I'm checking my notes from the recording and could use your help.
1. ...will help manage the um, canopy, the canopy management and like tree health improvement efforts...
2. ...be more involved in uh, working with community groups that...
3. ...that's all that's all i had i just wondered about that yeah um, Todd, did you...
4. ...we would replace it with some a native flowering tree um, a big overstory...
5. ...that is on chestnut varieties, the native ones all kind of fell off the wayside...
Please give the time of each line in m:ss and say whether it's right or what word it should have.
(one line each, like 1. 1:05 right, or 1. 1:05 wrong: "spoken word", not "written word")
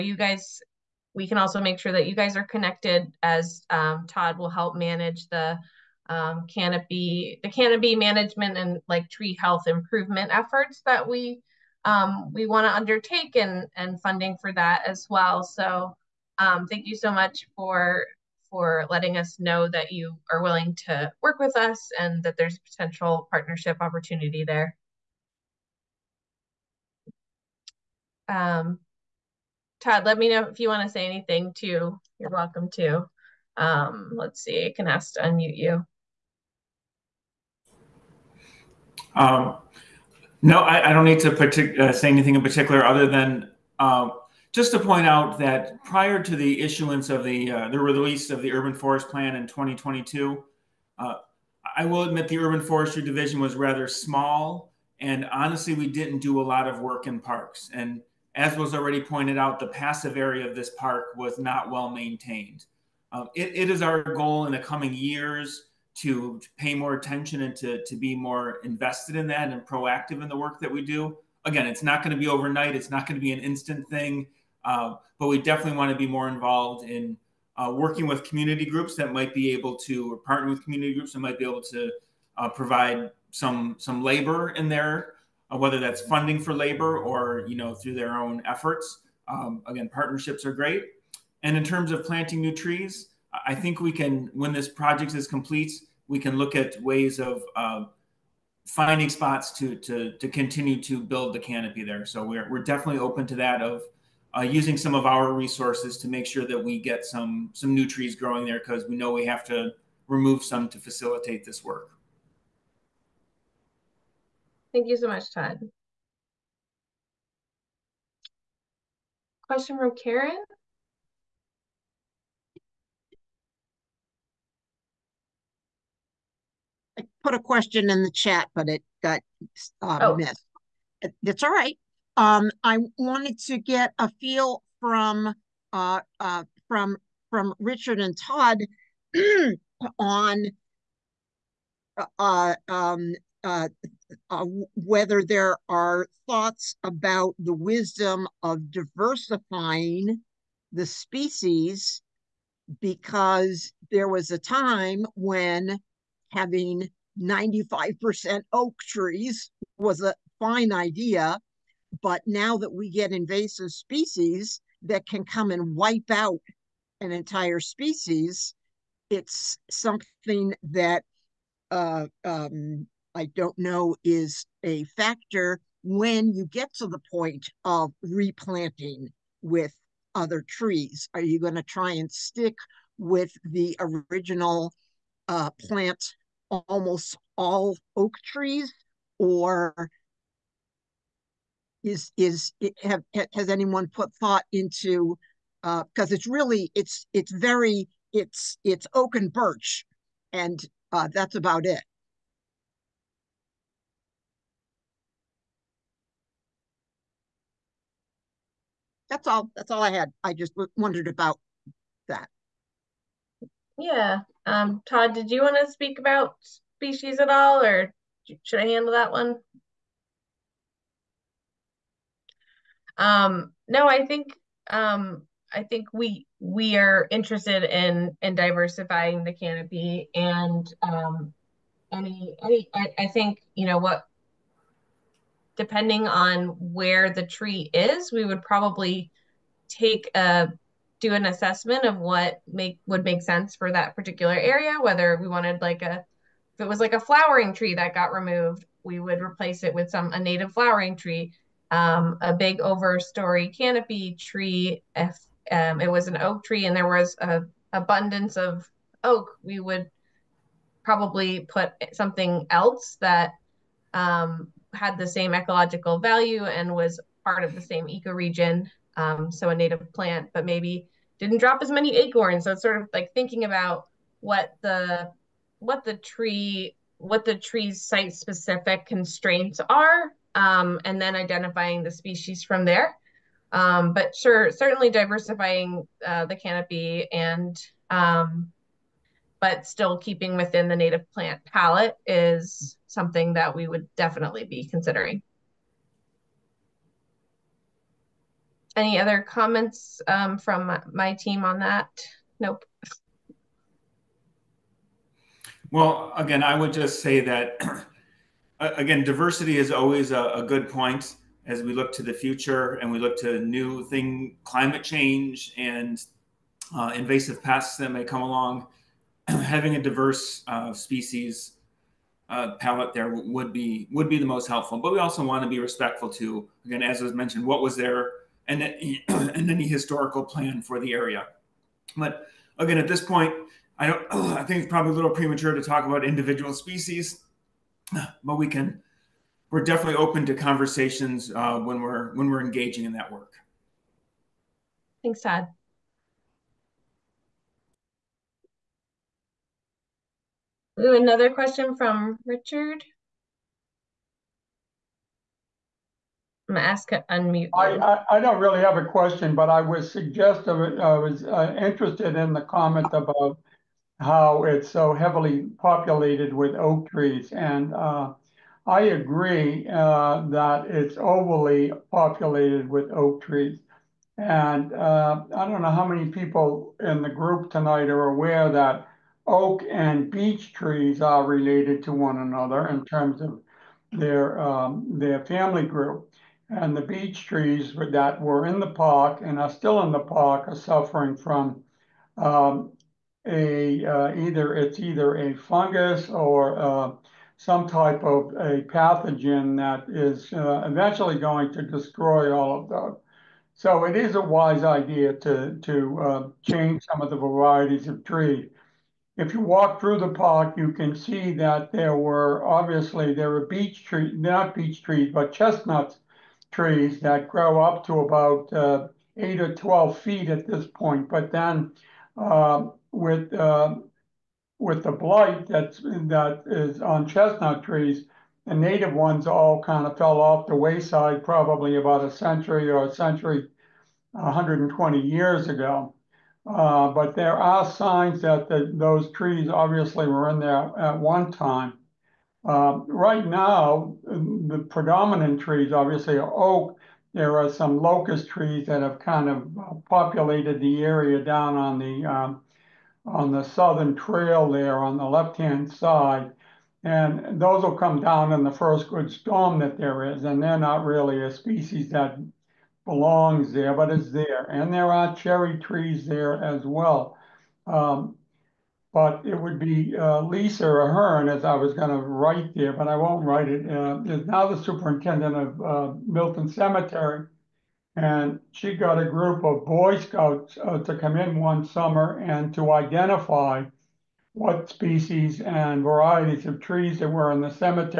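1. 0:04 right
2. 1:15 right
3. 3:29 right
4. 4:08 right
5. 7:05 wrong: "trees", not "varieties".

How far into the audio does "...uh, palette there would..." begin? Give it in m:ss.
5:22.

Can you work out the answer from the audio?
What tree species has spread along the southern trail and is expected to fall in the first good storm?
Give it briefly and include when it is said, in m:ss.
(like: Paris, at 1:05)
Locust, at 7:27.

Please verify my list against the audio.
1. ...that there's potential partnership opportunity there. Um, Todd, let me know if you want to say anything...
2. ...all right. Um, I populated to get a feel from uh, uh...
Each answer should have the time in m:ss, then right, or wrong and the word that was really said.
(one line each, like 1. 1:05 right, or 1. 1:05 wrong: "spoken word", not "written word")
1. 0:22 right
2. 2:11 wrong: "wanted", not "populated".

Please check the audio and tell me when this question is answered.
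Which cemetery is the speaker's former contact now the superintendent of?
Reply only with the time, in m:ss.
7:56.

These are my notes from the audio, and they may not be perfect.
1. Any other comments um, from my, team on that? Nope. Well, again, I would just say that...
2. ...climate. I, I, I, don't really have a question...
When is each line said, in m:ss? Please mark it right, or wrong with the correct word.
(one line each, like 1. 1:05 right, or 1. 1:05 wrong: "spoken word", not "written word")
1. 4:58 right
2. 5:57 wrong: "unmute", not "climate".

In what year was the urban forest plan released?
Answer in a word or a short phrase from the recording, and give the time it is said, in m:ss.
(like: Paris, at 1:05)
2022, at 0:49.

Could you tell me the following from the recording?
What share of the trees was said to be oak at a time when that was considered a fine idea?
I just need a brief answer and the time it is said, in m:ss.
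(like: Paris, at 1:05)
95%, at 2:37.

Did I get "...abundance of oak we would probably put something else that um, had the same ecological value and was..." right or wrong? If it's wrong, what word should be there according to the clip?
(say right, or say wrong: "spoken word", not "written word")
right.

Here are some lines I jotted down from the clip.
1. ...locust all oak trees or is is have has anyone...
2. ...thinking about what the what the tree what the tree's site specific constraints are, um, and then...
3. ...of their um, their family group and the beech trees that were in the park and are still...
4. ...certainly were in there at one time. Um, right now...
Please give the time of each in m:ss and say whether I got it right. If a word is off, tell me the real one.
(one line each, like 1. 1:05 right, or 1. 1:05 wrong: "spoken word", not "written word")
1. 3:06 wrong: "almost", not "locust"
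2. 4:33 right
3. 6:23 right
4. 7:19 wrong: "obviously", not "certainly".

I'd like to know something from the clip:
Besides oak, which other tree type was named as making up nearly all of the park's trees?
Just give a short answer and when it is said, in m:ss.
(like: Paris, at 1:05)
Birch, at 3:19.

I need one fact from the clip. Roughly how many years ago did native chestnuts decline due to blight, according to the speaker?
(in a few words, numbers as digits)
120 years.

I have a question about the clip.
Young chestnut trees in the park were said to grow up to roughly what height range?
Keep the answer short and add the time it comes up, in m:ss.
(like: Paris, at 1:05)
8 to 12 feet, at 6:59.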